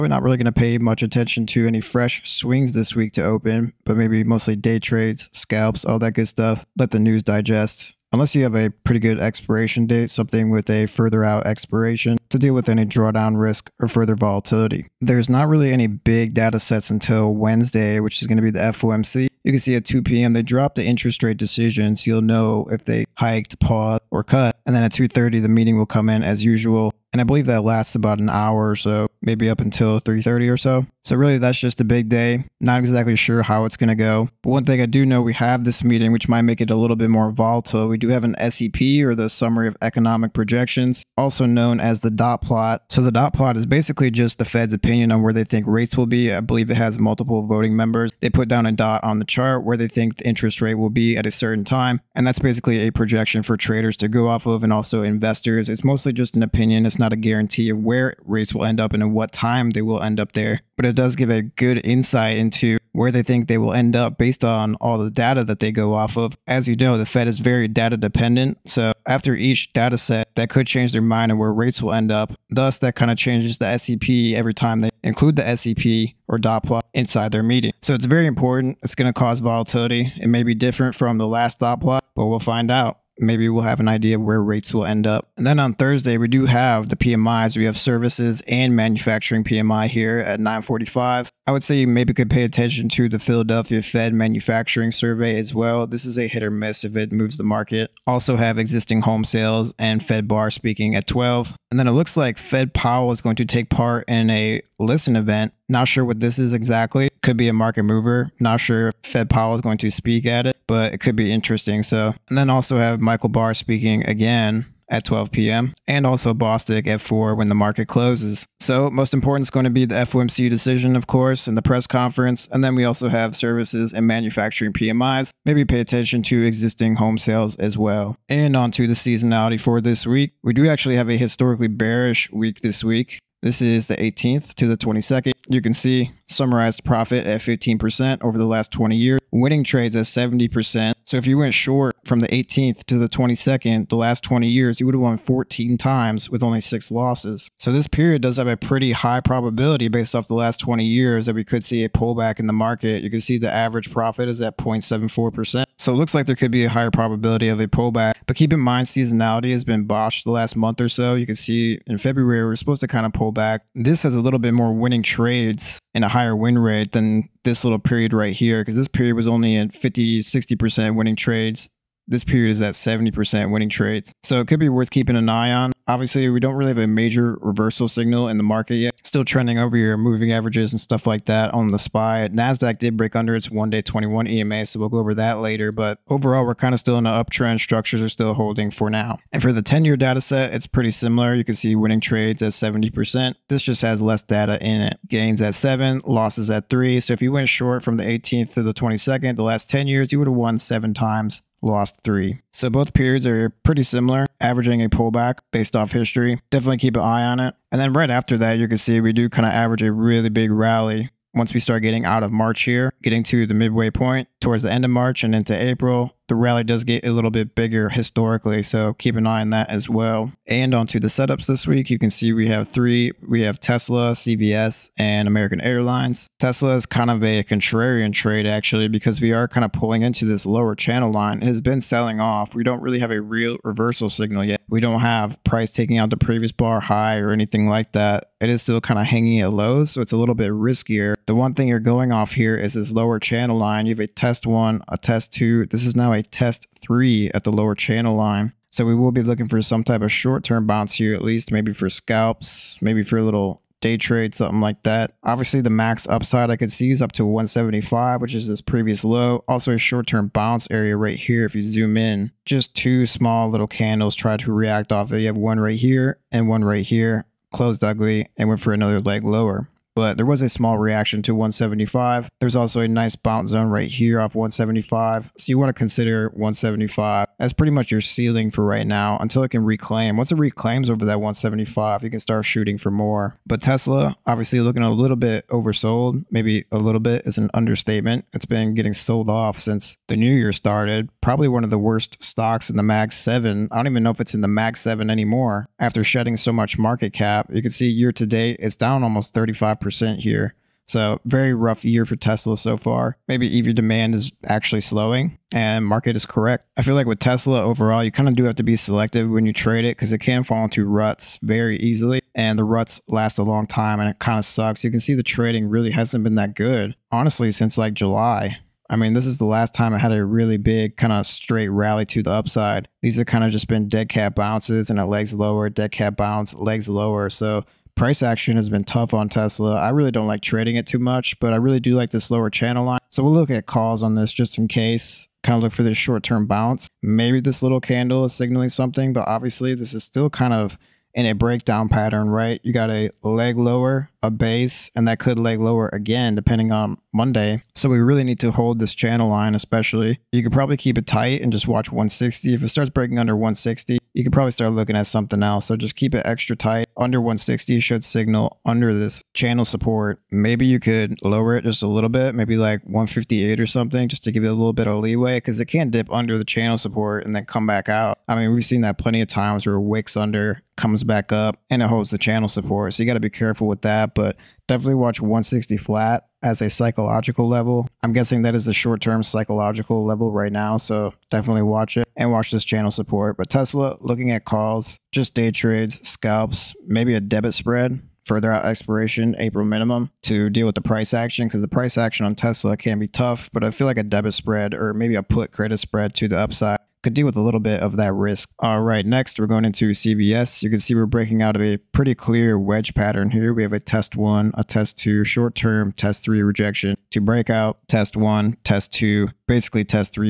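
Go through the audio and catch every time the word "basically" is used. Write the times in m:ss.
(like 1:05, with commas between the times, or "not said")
0:43, 0:52, 6:49.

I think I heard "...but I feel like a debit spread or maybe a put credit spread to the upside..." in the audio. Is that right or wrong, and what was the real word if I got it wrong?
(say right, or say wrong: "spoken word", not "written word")
right.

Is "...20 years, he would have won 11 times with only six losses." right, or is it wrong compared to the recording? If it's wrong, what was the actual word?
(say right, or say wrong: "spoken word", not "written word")
wrong: "14", not "11".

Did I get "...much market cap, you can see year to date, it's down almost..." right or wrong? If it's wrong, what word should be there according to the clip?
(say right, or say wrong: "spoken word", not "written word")
right.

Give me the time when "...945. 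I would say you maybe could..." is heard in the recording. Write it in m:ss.
1:30.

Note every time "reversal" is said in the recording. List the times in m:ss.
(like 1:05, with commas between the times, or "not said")
2:57, 3:53.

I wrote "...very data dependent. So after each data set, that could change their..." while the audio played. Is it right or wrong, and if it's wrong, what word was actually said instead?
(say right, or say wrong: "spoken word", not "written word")
right.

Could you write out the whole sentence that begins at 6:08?
I mean, we've seen that plenty of times where it wicks under comes back up and it holds the channel support.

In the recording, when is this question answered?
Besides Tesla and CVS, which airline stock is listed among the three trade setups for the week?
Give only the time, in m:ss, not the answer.
3:45.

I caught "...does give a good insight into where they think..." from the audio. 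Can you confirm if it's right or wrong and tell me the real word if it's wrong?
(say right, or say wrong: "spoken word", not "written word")
right.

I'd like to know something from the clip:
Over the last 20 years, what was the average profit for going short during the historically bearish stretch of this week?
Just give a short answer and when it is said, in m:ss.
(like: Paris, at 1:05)
0.74%, at 2:34.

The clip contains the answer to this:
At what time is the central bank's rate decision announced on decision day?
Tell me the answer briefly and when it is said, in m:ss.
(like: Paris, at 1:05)
2 p.m., at 0:19.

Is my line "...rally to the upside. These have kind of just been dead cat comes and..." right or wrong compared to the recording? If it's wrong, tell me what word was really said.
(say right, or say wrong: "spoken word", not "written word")
wrong: "bounces", not "comes".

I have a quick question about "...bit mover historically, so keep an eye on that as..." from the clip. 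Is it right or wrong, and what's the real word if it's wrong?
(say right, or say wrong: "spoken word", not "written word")
wrong: "bigger", not "mover".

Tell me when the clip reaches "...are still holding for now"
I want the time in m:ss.
3:08.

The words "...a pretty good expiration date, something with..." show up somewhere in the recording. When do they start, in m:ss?
0:08.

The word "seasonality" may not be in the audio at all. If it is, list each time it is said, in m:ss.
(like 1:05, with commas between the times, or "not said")
2:08, 2:38.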